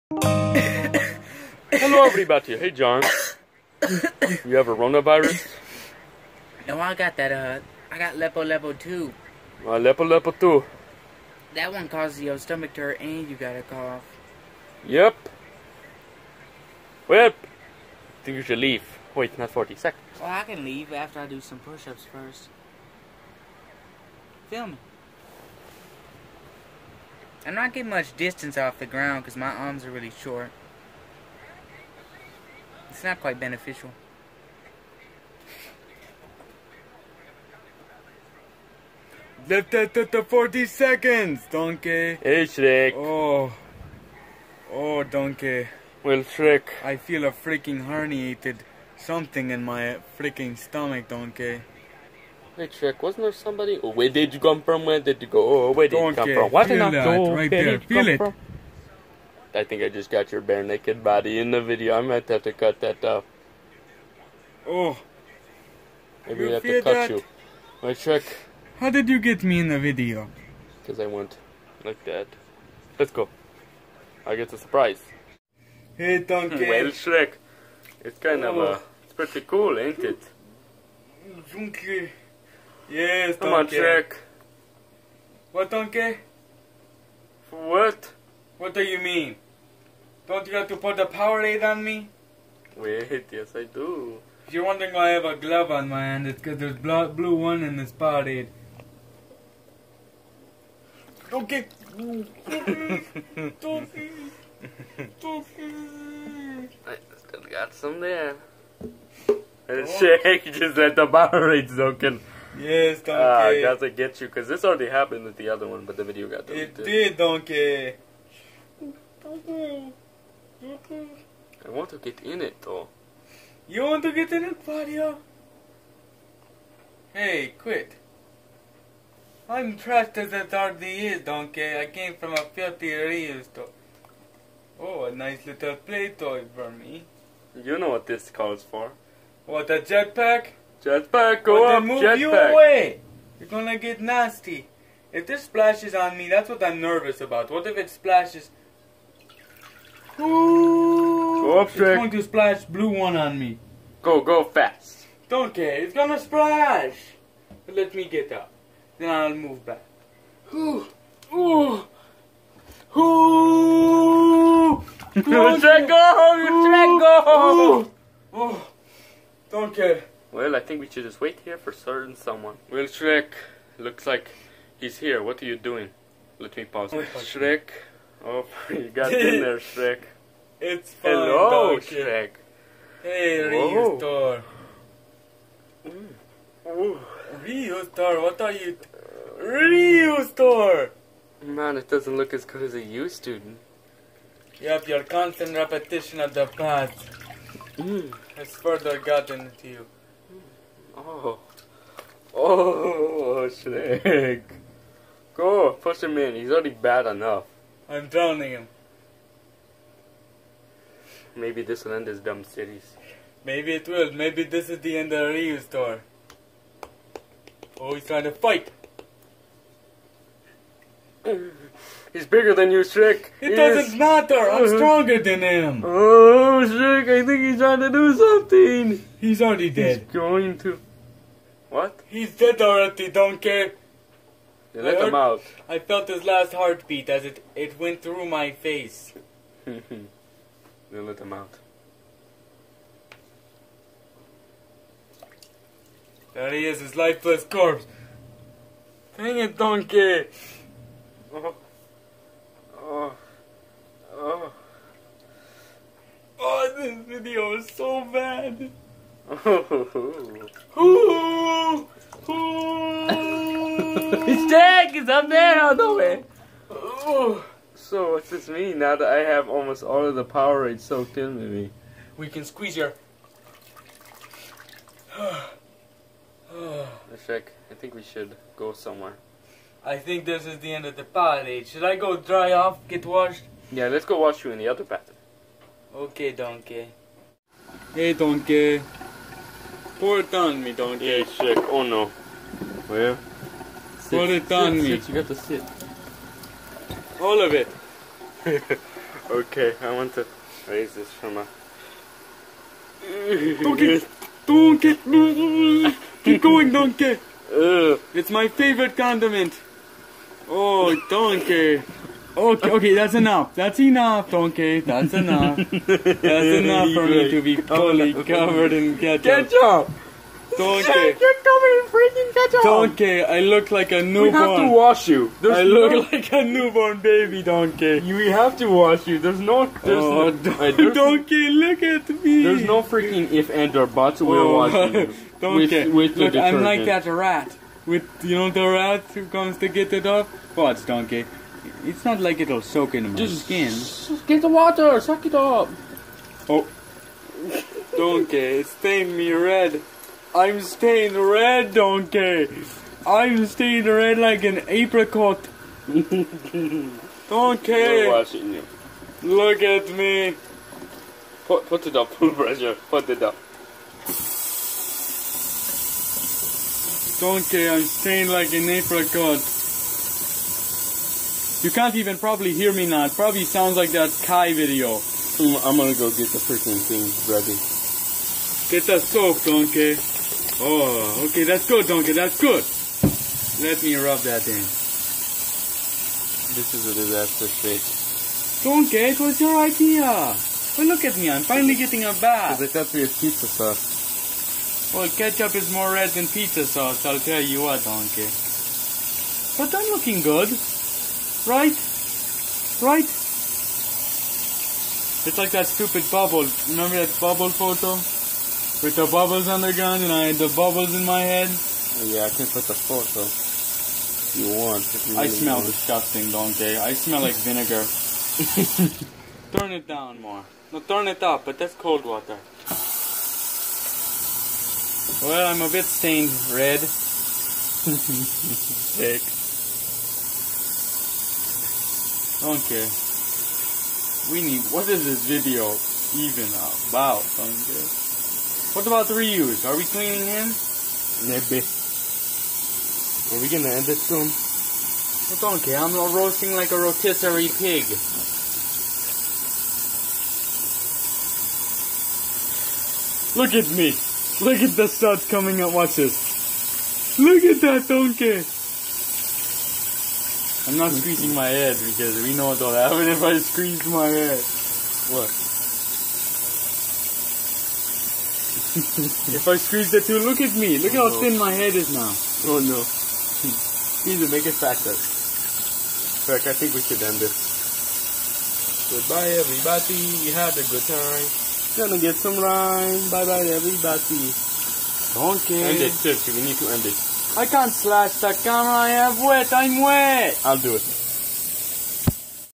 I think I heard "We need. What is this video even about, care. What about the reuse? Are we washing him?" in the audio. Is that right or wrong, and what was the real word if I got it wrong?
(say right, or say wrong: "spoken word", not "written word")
wrong: "cleaning", not "washing".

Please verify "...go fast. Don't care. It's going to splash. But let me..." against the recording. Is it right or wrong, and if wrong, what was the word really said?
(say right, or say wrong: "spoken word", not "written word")
right.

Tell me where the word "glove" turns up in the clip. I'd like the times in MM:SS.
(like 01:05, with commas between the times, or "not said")
01:35.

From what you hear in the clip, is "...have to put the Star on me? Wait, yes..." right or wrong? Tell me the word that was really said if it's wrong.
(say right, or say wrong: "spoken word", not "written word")
wrong: "Powerade", not "Star".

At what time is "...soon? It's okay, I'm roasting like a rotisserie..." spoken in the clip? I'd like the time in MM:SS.
07:24.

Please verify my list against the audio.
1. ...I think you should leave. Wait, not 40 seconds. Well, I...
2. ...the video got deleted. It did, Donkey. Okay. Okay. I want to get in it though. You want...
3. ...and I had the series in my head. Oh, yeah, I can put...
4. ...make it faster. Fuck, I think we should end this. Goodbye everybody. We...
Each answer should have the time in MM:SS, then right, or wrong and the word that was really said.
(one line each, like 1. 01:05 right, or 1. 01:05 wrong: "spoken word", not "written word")
1. 00:17 right
2. 01:55 right
3. 06:50 wrong: "bubbles", not "series"
4. 07:54 right.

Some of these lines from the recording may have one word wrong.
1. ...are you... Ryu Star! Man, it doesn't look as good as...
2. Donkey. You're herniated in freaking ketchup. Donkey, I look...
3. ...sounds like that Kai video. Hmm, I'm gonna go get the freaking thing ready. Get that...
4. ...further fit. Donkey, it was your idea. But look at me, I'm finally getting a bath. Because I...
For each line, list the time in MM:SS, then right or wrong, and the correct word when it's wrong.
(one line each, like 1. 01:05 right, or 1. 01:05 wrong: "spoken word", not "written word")
1. 03:08 right
2. 05:20 wrong: "covered", not "herniated"
3. 06:13 right
4. 06:26 wrong: "disaster", not "further".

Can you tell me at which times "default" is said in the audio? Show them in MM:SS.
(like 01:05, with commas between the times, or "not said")
not said.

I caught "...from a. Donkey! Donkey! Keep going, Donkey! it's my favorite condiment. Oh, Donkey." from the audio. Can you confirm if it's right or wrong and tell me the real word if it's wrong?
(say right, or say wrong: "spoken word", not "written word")
right.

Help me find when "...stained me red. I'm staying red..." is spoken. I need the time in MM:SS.
05:48.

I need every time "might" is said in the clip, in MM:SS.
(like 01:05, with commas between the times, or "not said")
01:02.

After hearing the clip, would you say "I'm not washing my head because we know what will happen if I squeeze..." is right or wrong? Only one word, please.
wrong.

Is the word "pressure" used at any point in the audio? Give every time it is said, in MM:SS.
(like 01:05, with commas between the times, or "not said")
06:02.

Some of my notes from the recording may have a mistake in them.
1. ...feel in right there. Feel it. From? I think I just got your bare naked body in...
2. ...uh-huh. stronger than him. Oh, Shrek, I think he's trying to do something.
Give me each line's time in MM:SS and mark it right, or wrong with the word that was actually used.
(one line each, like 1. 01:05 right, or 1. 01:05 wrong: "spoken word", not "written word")
1. 00:56 right
2. 03:44 right.